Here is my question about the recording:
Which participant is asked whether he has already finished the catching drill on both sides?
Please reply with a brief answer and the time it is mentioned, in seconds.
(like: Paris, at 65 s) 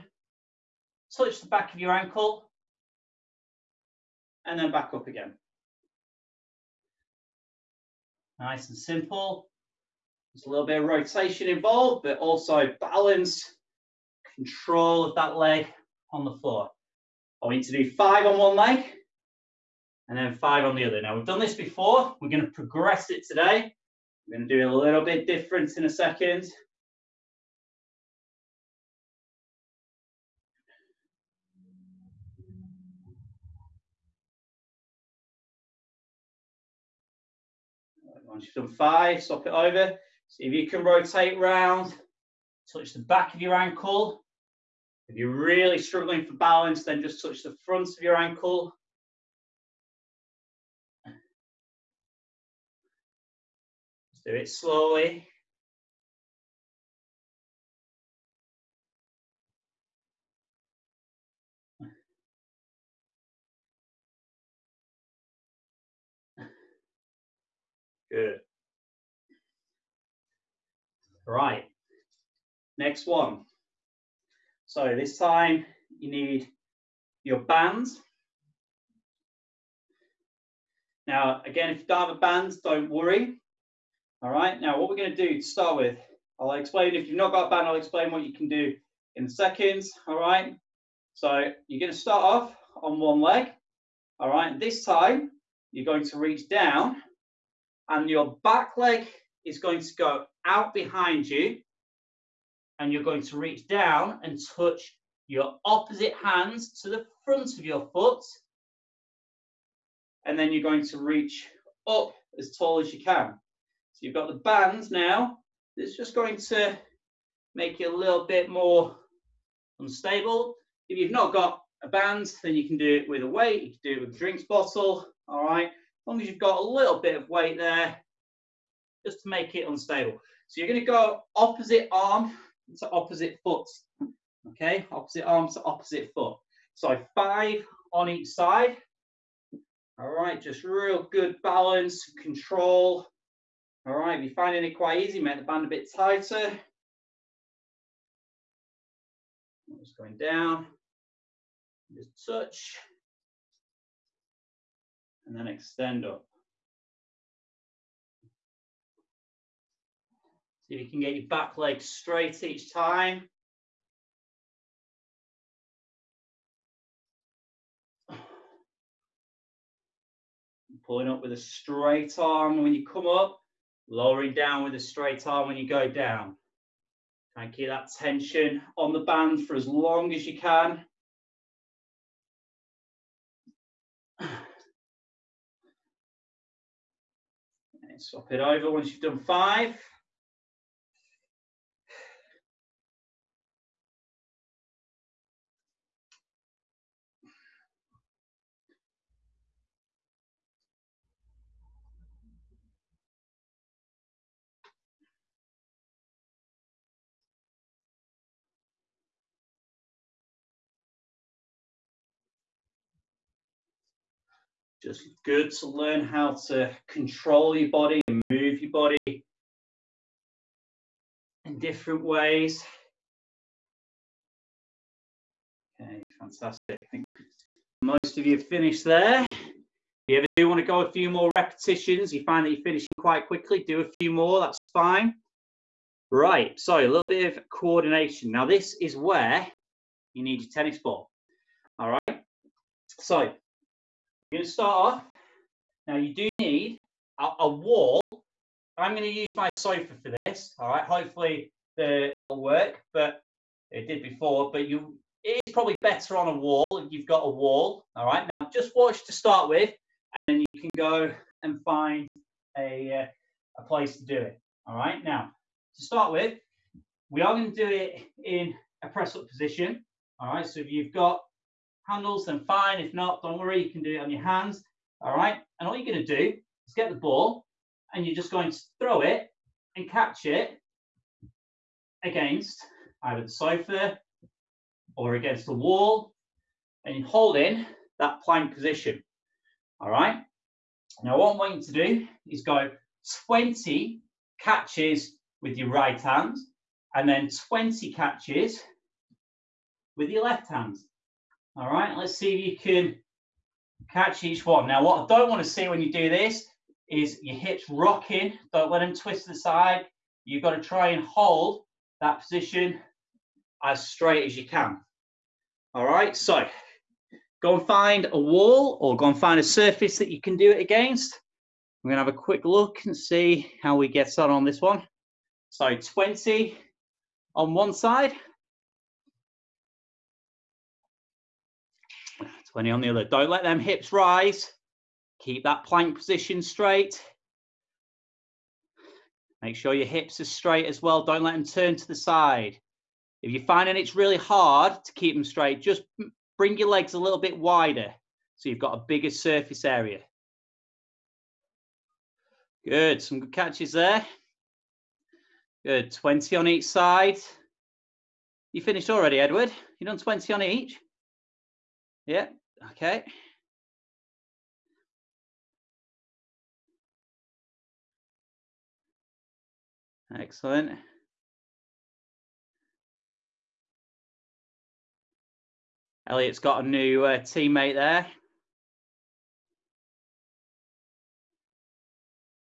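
Edward, at 359 s.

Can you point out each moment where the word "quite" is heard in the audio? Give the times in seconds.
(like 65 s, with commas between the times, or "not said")
144 s, 232 s.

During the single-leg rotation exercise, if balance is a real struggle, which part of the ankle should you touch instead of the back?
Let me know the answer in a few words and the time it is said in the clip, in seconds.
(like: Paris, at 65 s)
front of your ankle, at 47 s.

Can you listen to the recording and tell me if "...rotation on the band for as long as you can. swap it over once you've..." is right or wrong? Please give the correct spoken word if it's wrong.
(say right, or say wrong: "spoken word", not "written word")
wrong: "tension", not "rotation".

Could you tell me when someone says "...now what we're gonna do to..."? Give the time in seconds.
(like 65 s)
84 s.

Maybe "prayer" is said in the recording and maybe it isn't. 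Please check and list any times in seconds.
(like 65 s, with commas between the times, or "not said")
not said.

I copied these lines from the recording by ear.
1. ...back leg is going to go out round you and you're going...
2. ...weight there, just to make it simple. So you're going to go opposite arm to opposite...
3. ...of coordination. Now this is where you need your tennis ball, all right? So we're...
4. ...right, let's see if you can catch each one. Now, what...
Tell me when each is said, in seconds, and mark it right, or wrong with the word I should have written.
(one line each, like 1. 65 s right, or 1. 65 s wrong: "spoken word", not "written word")
1. 98 s wrong: "behind", not "round"
2. 127 s wrong: "unstable", not "simple"
3. 237 s right
4. 301 s right.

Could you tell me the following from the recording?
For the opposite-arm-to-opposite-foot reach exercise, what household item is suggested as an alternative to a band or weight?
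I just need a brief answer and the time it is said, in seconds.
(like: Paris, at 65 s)
drinks bottle, at 124 s.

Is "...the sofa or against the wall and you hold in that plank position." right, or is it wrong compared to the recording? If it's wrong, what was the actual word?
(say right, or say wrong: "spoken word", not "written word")
right.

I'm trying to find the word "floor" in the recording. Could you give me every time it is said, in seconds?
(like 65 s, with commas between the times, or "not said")
16 s.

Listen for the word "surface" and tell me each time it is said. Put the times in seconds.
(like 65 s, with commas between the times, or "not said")
319 s, 349 s.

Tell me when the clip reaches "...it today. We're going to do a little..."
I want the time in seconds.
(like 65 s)
23 s.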